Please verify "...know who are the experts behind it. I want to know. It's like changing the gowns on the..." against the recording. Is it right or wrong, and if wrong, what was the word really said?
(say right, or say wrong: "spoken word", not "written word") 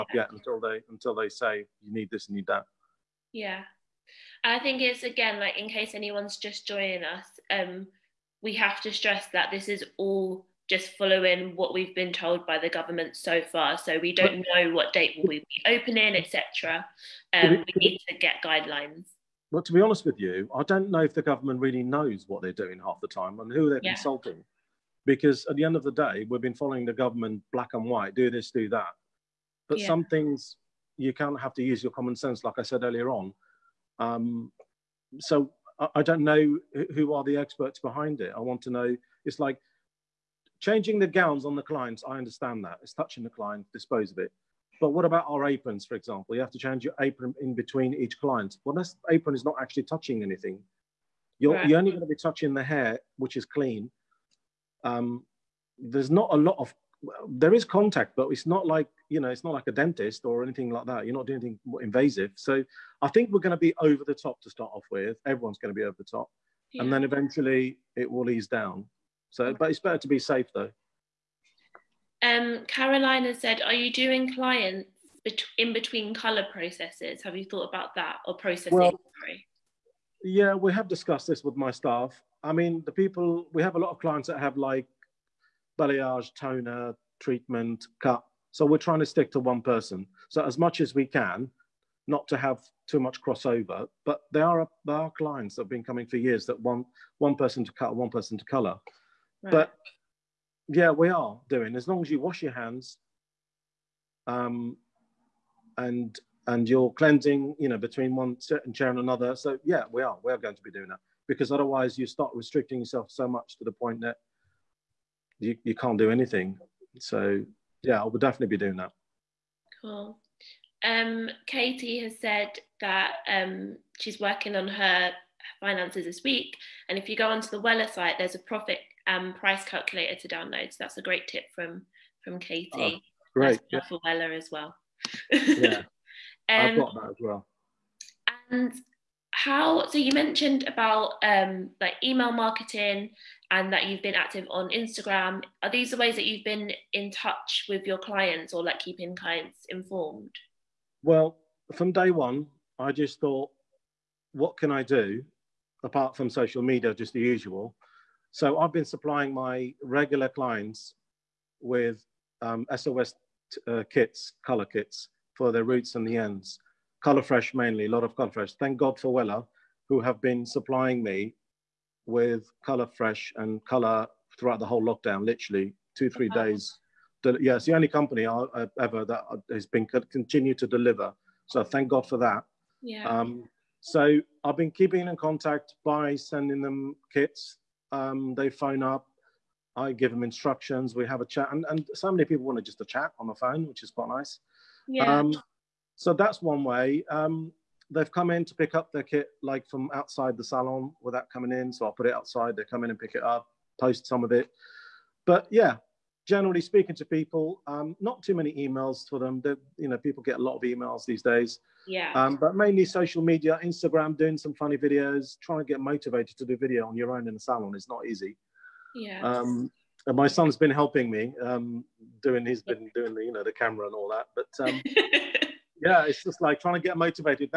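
right.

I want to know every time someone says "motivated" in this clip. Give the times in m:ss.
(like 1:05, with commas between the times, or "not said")
3:35, 3:46.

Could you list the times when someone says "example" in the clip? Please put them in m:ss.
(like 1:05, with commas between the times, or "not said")
0:45.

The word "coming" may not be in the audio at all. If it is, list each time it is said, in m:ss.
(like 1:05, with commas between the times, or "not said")
1:35, 3:21.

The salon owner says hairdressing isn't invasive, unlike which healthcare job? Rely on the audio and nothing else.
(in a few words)
Dentist.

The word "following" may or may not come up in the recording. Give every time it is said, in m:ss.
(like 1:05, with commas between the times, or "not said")
0:10, 0:26.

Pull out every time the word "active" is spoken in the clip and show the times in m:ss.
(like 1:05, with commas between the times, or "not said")
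2:24.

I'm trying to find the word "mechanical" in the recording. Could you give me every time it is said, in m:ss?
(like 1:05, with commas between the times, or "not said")
not said.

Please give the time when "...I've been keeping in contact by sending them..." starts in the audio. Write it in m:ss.
3:04.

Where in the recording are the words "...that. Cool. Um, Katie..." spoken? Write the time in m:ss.
1:58.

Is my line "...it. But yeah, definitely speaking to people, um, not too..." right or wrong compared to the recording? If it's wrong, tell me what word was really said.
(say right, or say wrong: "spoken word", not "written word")
wrong: "generally", not "definitely".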